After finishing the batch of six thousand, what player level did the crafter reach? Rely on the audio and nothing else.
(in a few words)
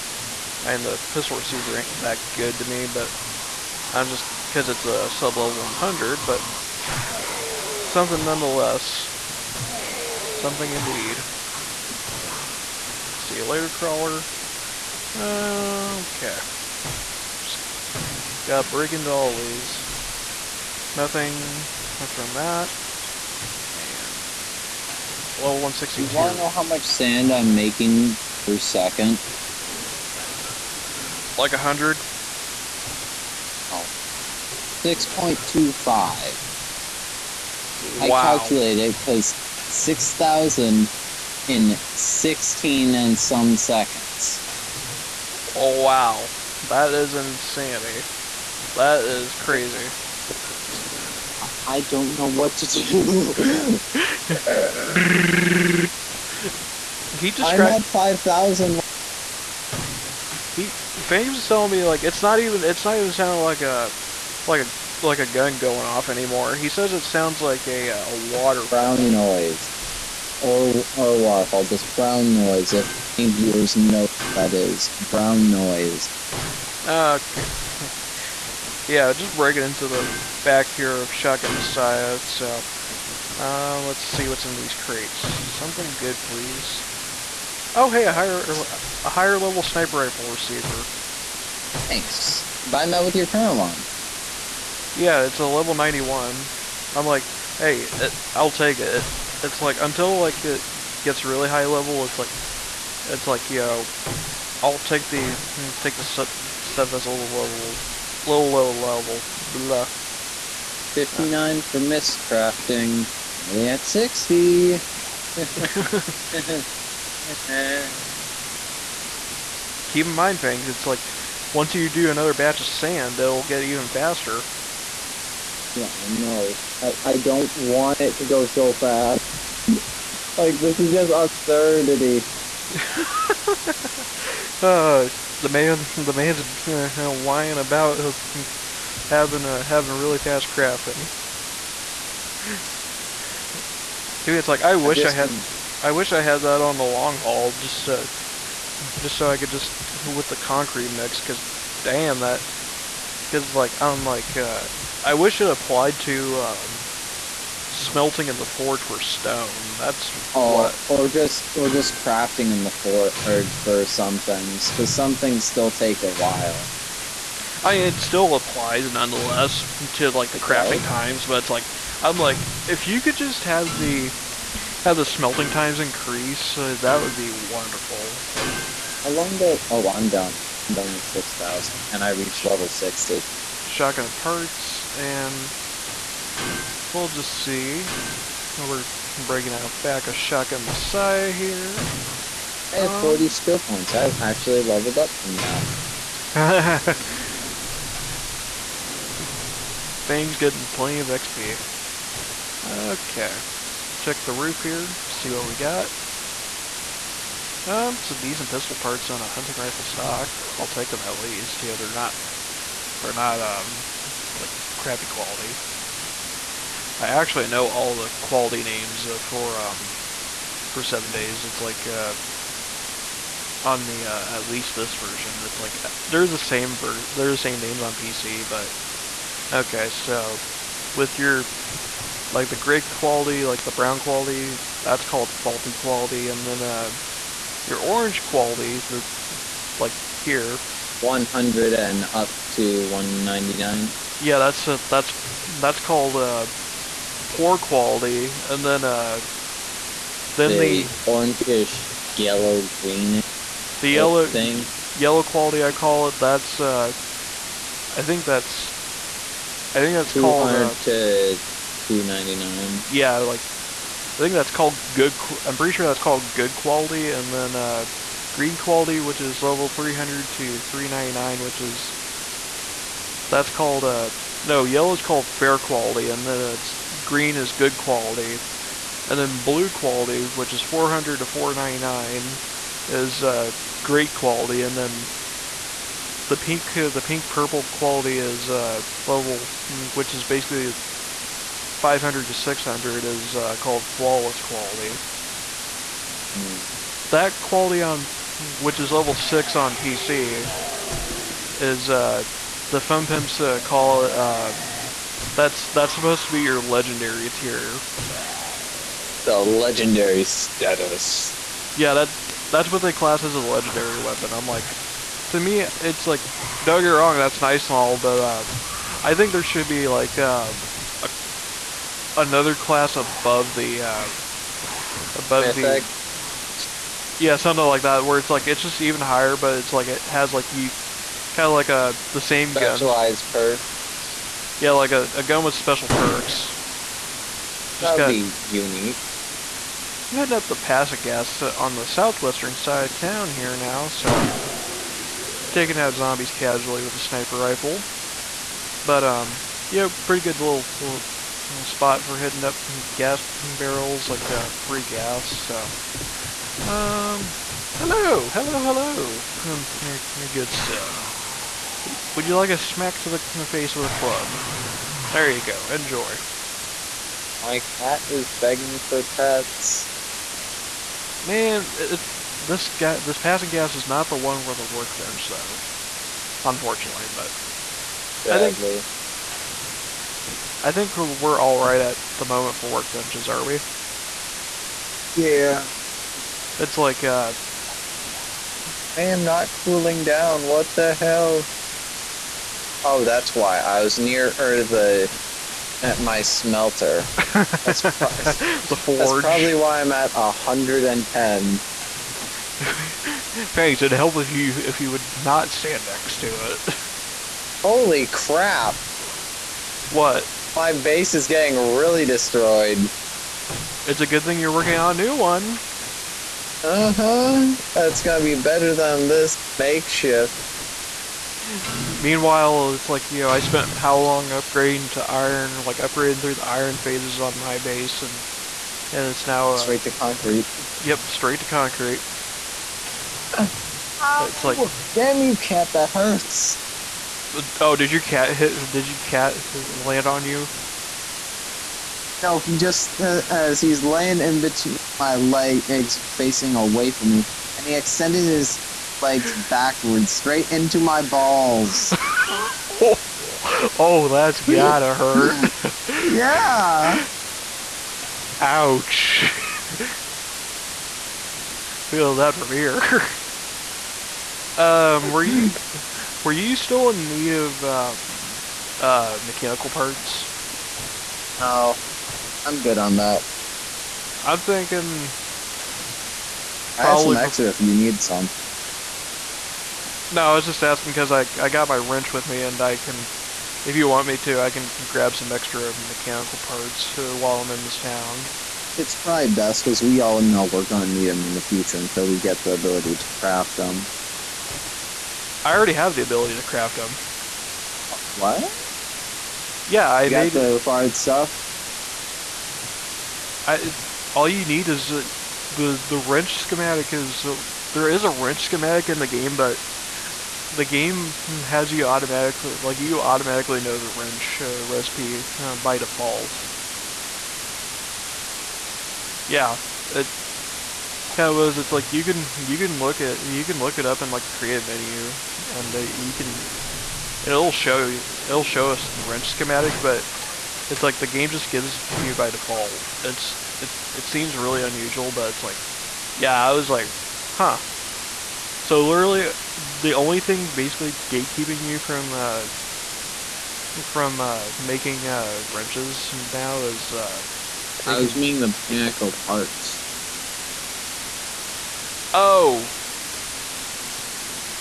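60.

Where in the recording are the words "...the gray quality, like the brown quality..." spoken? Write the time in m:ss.
3:52.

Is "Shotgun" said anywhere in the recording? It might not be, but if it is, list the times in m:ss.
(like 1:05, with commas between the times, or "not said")
1:21, 3:03, 3:10.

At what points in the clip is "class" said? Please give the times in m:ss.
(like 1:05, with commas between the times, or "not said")
5:12, 5:22.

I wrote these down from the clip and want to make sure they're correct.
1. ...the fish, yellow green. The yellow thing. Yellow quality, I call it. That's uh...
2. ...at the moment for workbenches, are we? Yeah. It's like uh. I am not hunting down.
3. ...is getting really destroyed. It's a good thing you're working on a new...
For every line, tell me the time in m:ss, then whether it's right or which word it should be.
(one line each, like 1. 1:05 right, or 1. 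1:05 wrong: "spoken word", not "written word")
1. 4:10 right
2. 6:21 wrong: "cooling", not "hunting"
3. 6:51 right.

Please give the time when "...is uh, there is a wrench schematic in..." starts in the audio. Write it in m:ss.
8:26.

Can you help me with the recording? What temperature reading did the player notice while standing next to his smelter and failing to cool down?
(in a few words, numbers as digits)
110.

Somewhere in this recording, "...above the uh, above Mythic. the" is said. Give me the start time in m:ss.
5:22.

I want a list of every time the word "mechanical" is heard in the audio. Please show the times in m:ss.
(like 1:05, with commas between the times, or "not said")
7:49, 8:05, 9:08.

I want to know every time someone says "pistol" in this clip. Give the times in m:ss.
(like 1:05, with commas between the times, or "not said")
0:01, 3:28.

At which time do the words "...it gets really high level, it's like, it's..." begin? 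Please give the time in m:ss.
1:40.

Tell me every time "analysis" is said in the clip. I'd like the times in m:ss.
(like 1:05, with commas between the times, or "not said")
not said.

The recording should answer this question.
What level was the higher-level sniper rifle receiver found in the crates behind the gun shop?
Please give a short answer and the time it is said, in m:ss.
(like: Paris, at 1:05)
91, at 1:35.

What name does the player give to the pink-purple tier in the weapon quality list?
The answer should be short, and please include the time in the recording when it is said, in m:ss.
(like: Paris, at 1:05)
flawless, at 4:53.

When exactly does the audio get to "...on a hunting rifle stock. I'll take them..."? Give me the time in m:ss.
3:29.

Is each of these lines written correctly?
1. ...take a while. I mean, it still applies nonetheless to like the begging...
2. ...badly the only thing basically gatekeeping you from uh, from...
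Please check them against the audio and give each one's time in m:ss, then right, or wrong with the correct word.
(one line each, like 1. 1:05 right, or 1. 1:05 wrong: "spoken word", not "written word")
1. 2:45 wrong: "crafting", not "begging"
2. 8:58 wrong: "literally", not "badly".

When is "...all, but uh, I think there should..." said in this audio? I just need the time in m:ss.
5:17.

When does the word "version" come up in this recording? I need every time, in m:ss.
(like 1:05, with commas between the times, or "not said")
3:44.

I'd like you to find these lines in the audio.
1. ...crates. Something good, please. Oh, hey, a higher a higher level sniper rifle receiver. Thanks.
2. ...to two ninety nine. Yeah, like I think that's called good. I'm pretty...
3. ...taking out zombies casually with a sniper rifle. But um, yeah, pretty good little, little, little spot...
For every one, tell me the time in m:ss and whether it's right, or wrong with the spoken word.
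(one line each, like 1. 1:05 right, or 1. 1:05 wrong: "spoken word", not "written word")
1. 1:24 right
2. 4:20 right
3. 5:45 right.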